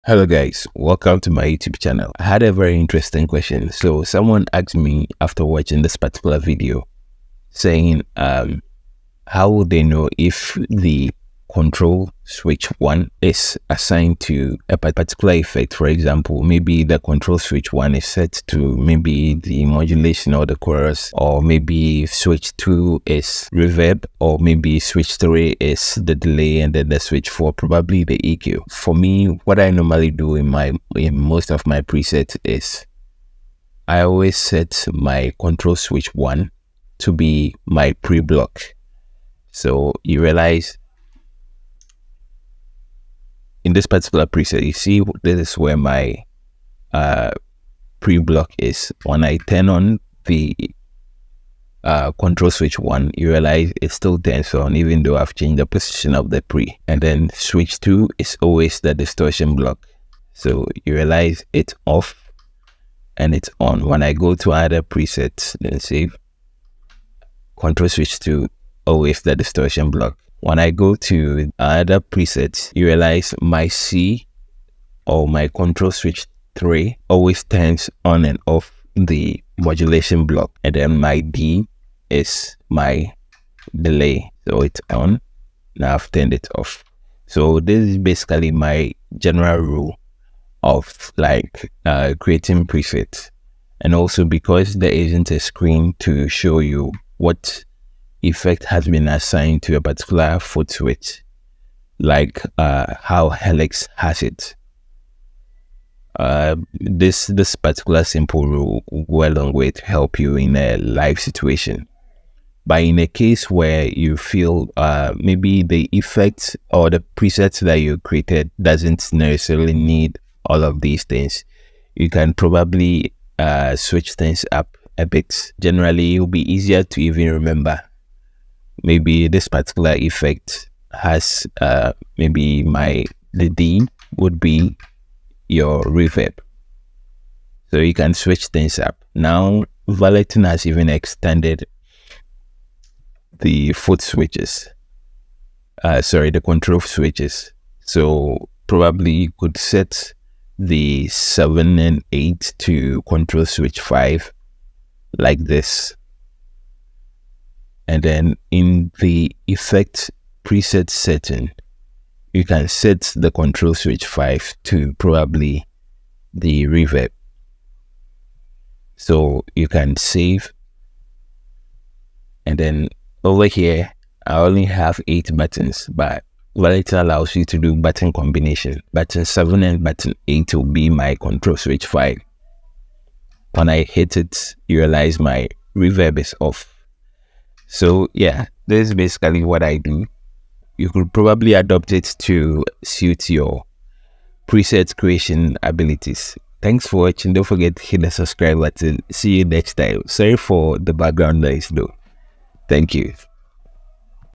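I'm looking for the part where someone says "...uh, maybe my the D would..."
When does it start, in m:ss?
2:11.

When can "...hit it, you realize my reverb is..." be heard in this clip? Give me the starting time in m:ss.
3:03.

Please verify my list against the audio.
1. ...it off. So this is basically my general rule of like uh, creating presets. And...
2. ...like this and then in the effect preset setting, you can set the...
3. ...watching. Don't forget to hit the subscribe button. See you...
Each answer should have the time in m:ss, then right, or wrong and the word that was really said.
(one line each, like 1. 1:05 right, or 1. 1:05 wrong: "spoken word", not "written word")
1. 1:26 right
2. 2:35 right
3. 3:17 right.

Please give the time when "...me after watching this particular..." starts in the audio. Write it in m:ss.
0:04.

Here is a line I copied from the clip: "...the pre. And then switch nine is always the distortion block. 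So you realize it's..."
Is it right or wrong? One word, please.
wrong.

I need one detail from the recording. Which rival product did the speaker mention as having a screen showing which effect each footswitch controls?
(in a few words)
Helix.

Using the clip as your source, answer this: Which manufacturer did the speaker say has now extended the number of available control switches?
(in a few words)
Valeton.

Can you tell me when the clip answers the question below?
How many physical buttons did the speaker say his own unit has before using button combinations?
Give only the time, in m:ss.
2:55.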